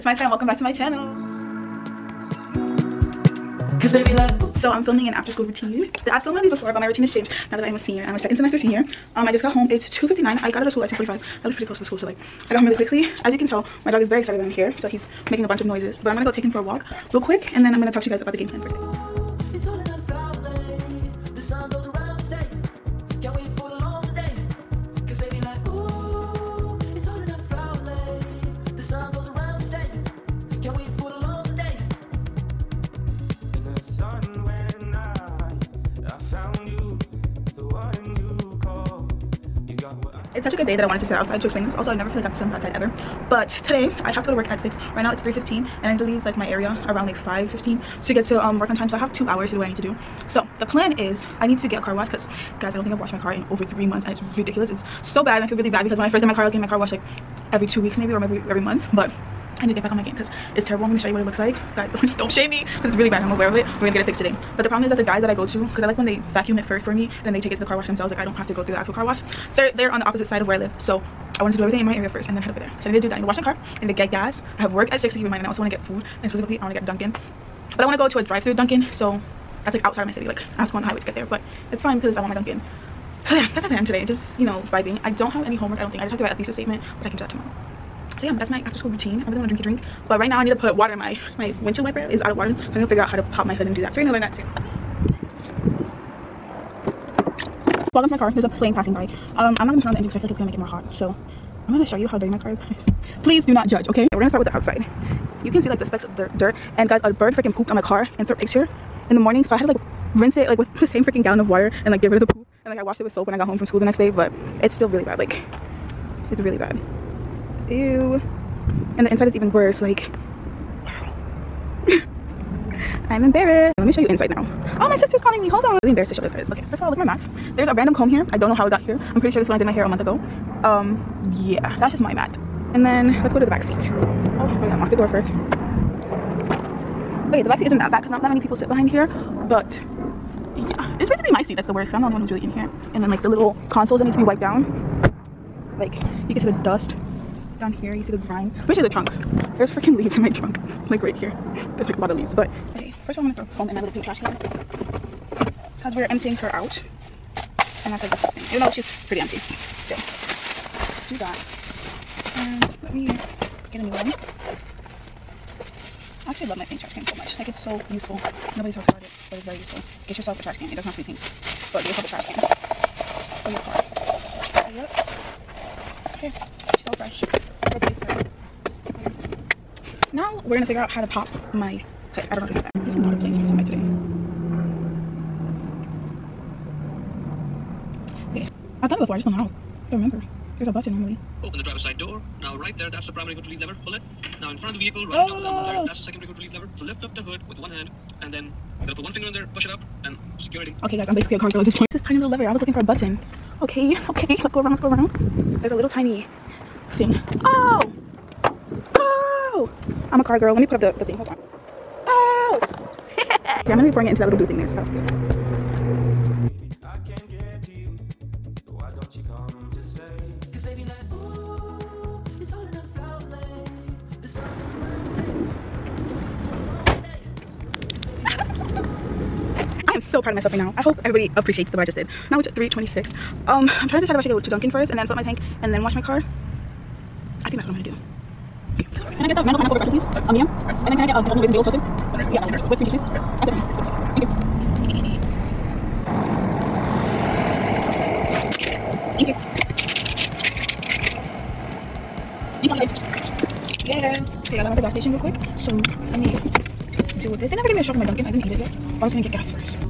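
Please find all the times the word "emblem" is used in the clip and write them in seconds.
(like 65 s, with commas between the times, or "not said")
195 s.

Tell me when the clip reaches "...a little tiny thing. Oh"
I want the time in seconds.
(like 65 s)
205 s.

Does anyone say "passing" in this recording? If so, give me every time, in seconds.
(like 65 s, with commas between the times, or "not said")
98 s, 183 s.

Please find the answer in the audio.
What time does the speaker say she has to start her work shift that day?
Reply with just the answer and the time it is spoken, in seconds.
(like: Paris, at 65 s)
6, at 44 s.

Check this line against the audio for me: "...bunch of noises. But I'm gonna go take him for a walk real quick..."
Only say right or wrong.
right.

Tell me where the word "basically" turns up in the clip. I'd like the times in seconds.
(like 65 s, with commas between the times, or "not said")
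141 s, 201 s.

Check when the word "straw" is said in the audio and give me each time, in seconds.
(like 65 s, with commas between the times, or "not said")
257 s.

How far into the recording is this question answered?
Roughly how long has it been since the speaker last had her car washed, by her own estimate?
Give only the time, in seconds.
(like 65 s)
53 s.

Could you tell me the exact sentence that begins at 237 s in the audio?
I think that's what I'm gonna do.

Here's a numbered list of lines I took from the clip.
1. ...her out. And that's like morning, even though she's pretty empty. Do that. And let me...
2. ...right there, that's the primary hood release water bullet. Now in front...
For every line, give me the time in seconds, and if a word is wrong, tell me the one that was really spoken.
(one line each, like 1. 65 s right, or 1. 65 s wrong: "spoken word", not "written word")
1. 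156 s wrong: "disgusting", not "morning"
2. 192 s wrong: "lever", not "water".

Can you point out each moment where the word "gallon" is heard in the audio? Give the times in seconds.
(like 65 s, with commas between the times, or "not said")
111 s.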